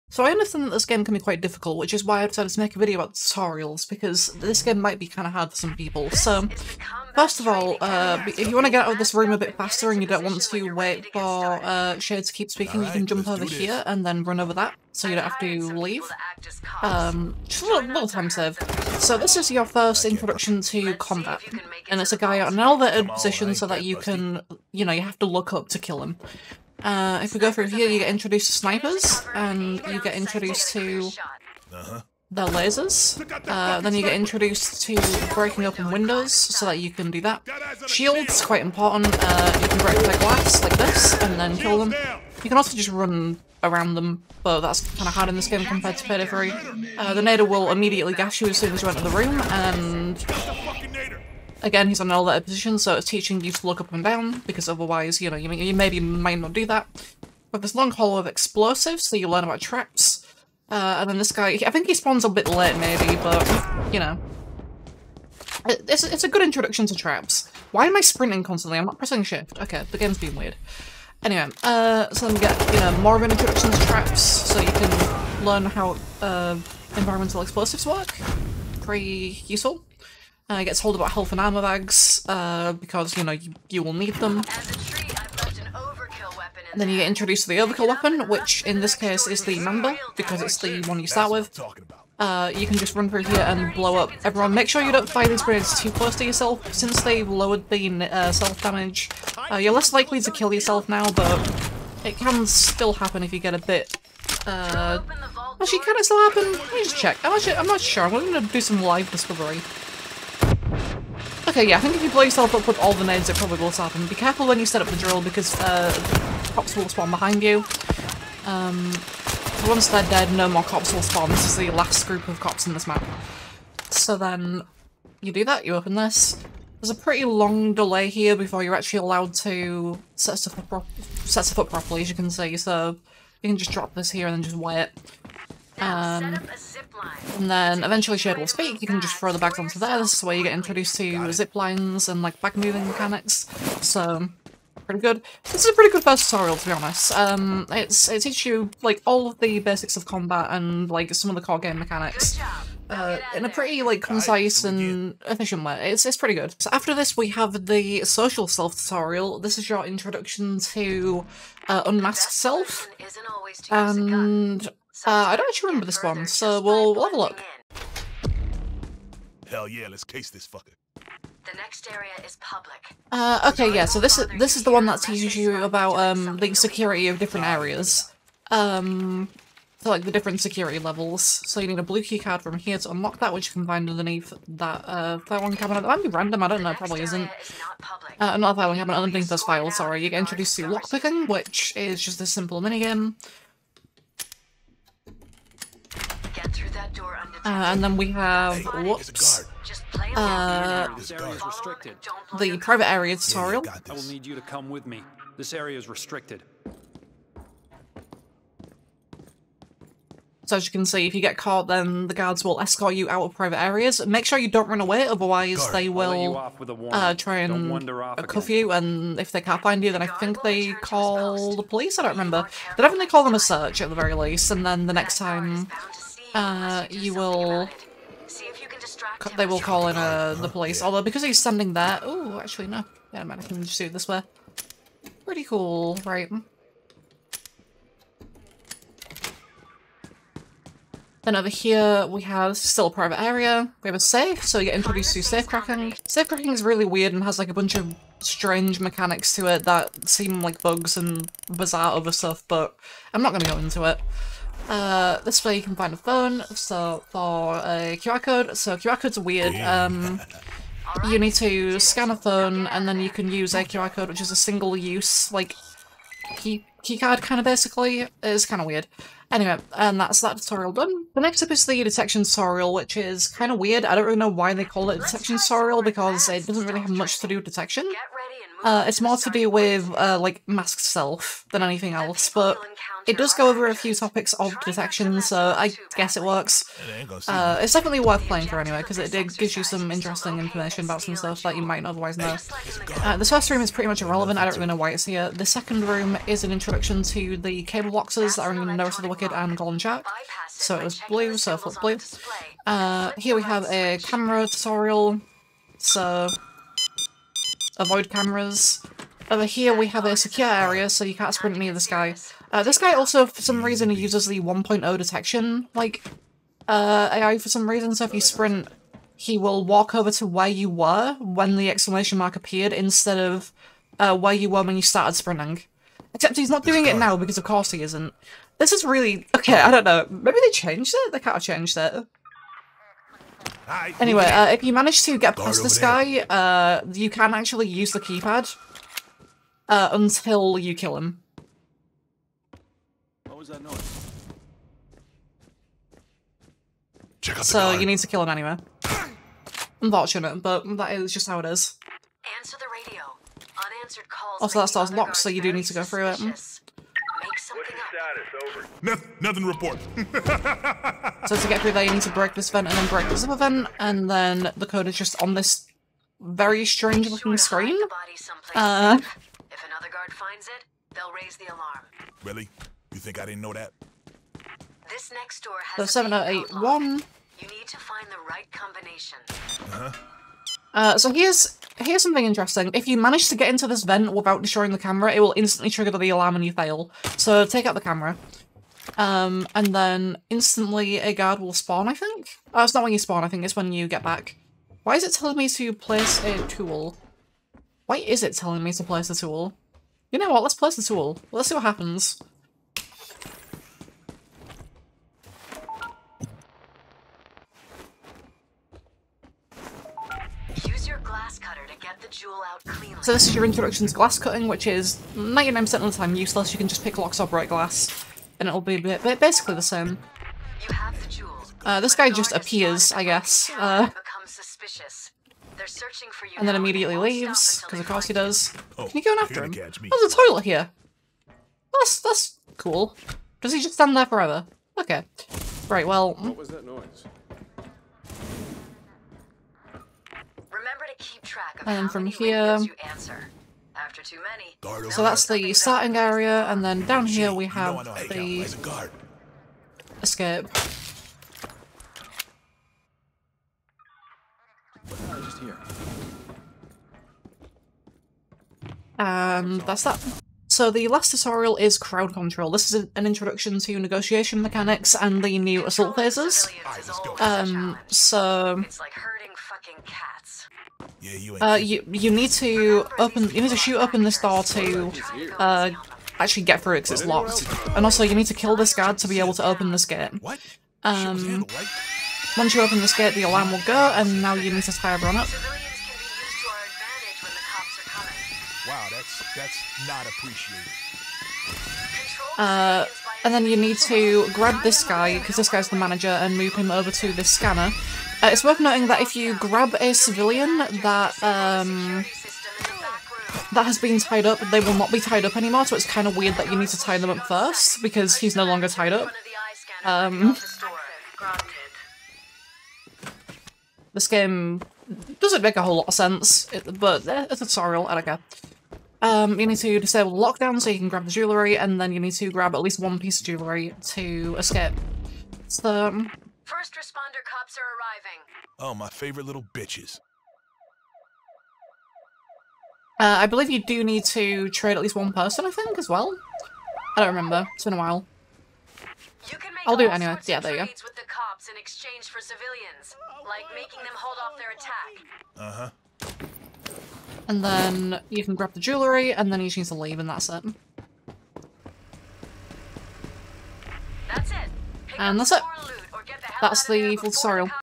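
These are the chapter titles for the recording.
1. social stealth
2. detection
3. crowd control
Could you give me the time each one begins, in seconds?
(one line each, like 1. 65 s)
1. 157 s
2. 271 s
3. 460 s.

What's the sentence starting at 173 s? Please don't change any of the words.
Uh, okay, yeah, so this is this is the one that teaches you about um the security of different areas.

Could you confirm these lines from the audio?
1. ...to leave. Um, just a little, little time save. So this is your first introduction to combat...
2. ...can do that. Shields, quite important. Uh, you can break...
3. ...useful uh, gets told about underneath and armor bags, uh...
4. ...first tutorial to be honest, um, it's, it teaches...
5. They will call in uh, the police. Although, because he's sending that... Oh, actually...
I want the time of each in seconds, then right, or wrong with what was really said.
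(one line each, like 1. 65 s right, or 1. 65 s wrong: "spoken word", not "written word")
1. 15 s right
2. 36 s right
3. 79 s wrong: "health", not "underneath"
4. 146 s right
5. 229 s right.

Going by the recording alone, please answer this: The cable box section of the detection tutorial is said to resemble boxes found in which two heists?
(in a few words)
Wicked and Golden Jack.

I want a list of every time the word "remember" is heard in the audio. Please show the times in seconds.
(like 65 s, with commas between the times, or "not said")
165 s, 222 s, 537 s.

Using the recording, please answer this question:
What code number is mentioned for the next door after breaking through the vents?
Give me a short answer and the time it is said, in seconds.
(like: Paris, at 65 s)
7081, at 375 s.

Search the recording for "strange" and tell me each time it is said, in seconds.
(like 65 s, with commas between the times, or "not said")
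248 s, 366 s.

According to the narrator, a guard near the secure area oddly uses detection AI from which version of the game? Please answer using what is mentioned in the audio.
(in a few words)
1.0.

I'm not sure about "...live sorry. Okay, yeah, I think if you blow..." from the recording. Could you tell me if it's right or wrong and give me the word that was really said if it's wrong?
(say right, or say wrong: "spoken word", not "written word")
wrong: "discovery", not "sorry".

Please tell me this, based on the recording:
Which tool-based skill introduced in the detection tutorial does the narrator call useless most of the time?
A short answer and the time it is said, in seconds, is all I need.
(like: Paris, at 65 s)
Glass cutting, at 413 s.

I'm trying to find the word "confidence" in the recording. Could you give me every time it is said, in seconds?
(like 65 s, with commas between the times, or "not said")
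not said.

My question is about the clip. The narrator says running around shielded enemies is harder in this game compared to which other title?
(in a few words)
Payday 3.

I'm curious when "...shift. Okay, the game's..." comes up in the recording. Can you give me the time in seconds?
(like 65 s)
69 s.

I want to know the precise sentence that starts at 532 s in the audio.
Uh, I believe you do need to trade at least one person, I think, as well.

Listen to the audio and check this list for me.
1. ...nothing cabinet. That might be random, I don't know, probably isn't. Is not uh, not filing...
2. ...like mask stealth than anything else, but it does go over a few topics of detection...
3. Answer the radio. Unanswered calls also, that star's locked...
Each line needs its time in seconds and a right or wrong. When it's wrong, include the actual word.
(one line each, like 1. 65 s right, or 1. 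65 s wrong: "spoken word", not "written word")
1. 185 s wrong: "filing", not "nothing"
2. 280 s right
3. 352 s right.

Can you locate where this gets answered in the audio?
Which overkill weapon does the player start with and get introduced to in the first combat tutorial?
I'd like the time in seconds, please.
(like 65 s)
89 s.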